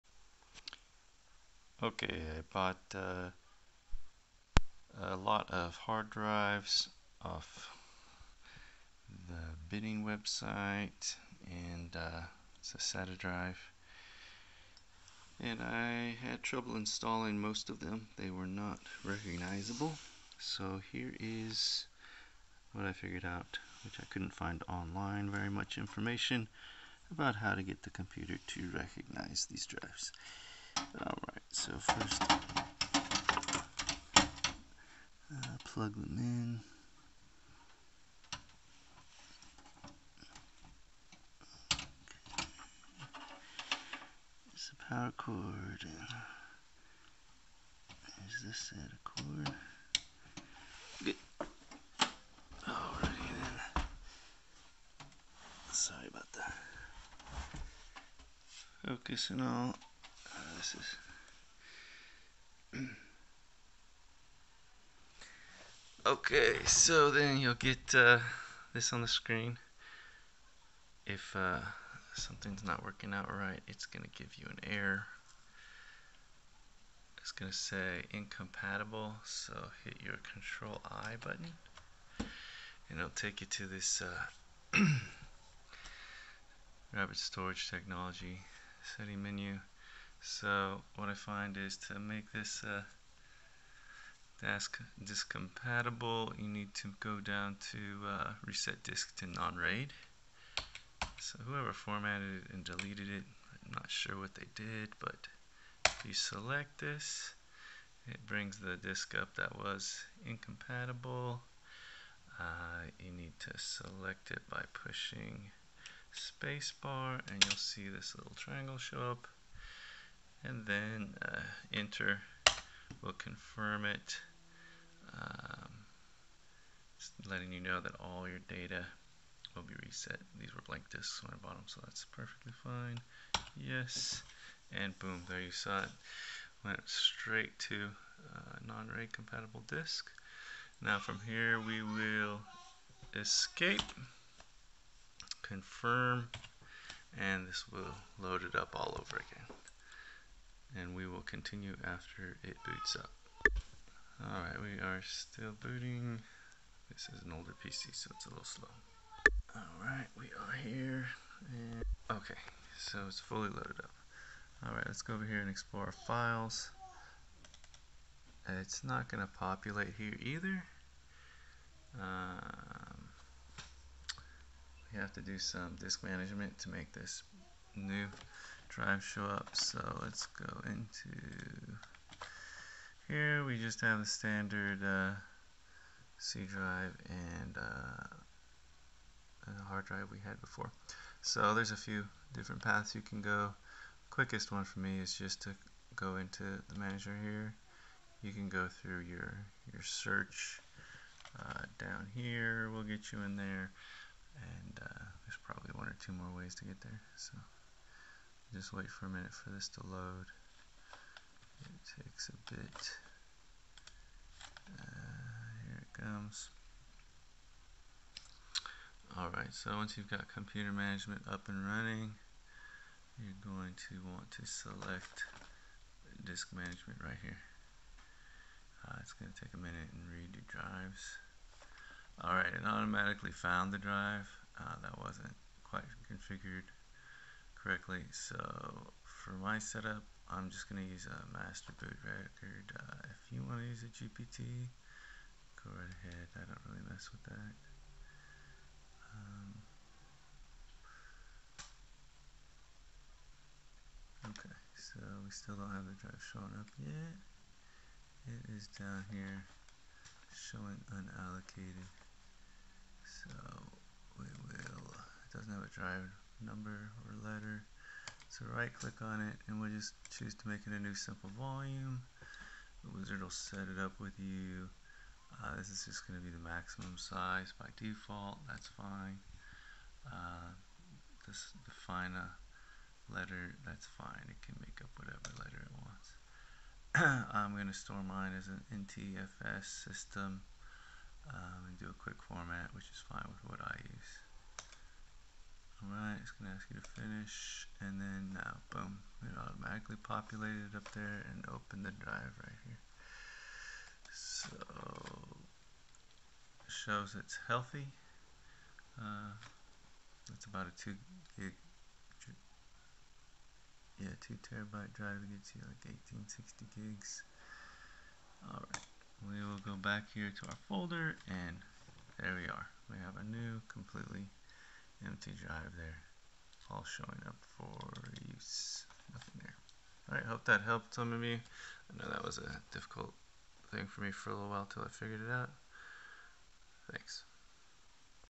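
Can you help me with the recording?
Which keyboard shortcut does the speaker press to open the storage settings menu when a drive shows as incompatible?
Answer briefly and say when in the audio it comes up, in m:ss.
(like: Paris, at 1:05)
Control I, at 1:20.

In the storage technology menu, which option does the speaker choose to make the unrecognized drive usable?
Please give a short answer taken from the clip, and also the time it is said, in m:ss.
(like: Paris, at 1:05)
Reset disk to non-RAID, at 1:38.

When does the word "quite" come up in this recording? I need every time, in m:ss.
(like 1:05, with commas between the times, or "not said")
3:55.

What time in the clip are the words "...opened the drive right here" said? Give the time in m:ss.
5:01.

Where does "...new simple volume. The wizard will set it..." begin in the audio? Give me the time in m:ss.
4:30.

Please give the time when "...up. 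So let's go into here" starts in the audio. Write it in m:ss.
2:59.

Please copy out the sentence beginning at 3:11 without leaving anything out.
So there's a few different paths you can go.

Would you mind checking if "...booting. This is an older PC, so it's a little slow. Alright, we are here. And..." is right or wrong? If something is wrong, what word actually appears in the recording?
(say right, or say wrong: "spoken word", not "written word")
right.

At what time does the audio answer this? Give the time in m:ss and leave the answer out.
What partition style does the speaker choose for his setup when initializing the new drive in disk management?
4:01.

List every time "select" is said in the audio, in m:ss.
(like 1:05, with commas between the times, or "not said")
1:46, 1:53, 3:44.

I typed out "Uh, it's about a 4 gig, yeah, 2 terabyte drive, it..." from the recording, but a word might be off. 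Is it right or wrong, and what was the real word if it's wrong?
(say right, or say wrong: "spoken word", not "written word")
wrong: "2", not "4".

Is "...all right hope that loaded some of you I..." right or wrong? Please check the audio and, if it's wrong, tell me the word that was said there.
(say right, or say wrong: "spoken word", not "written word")
wrong: "helped", not "loaded".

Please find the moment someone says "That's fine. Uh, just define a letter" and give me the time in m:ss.
4:38.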